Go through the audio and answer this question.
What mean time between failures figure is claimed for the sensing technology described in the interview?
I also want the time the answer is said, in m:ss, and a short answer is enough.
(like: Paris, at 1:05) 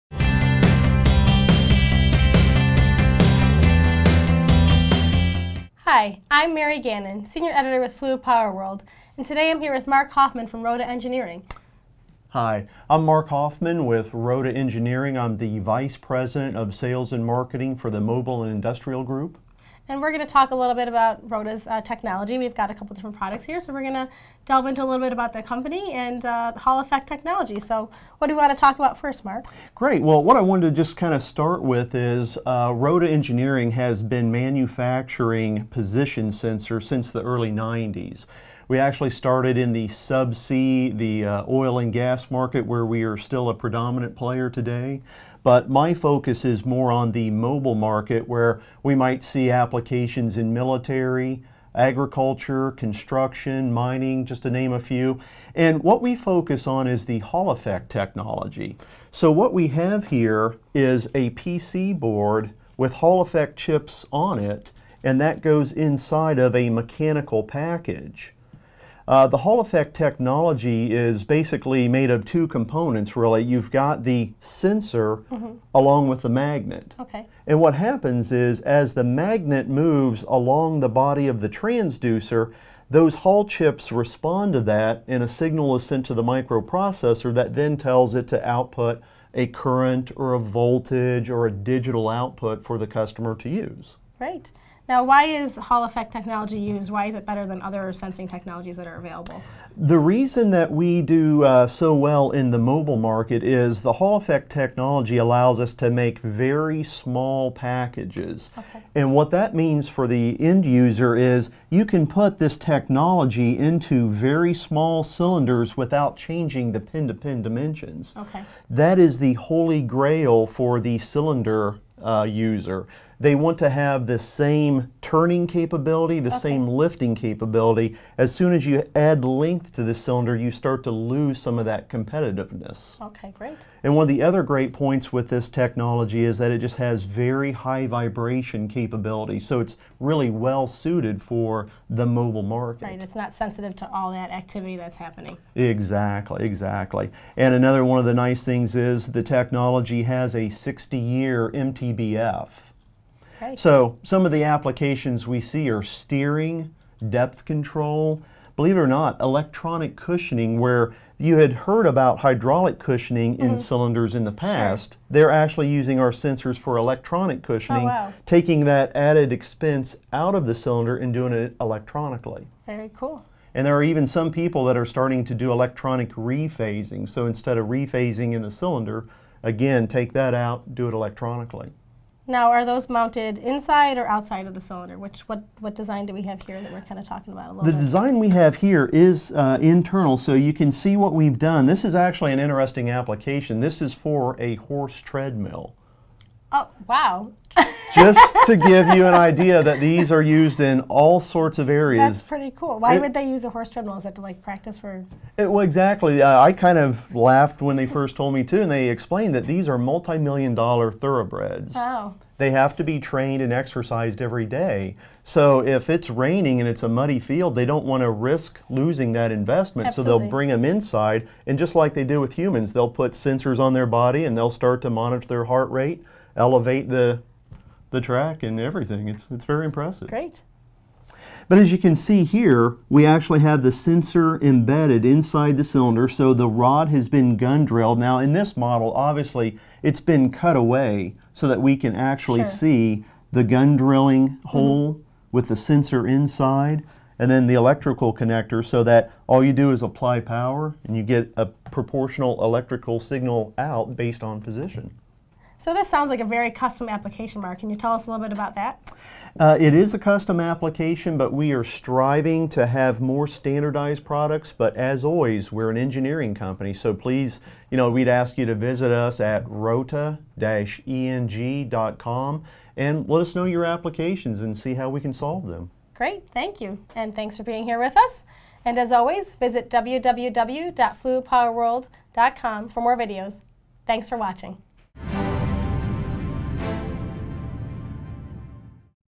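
60 years, at 2:30.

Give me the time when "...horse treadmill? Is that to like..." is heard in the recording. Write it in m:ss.
3:23.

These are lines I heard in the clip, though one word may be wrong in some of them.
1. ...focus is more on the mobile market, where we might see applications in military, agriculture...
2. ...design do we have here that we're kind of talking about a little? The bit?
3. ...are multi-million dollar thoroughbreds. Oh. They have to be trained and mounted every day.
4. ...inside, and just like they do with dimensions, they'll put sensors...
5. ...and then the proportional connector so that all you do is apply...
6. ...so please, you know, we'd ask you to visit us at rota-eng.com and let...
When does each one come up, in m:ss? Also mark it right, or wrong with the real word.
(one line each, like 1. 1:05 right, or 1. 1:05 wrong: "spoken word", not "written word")
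1. 0:45 right
2. 3:05 right
3. 3:29 wrong: "exercised", not "mounted"
4. 3:40 wrong: "humans", not "dimensions"
5. 4:07 wrong: "electrical", not "proportional"
6. 4:26 right.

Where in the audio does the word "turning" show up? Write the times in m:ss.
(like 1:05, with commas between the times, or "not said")
2:04.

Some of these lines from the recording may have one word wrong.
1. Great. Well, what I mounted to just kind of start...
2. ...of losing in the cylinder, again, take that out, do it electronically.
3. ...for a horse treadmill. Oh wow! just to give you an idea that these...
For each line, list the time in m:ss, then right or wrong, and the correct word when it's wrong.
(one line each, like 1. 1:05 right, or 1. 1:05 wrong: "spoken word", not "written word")
1. 0:29 wrong: "wanted", not "mounted"
2. 2:57 wrong: "rephasing", not "losing"
3. 3:13 right.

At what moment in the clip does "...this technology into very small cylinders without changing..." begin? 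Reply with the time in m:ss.
1:52.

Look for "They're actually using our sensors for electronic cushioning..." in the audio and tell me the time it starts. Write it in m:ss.
2:45.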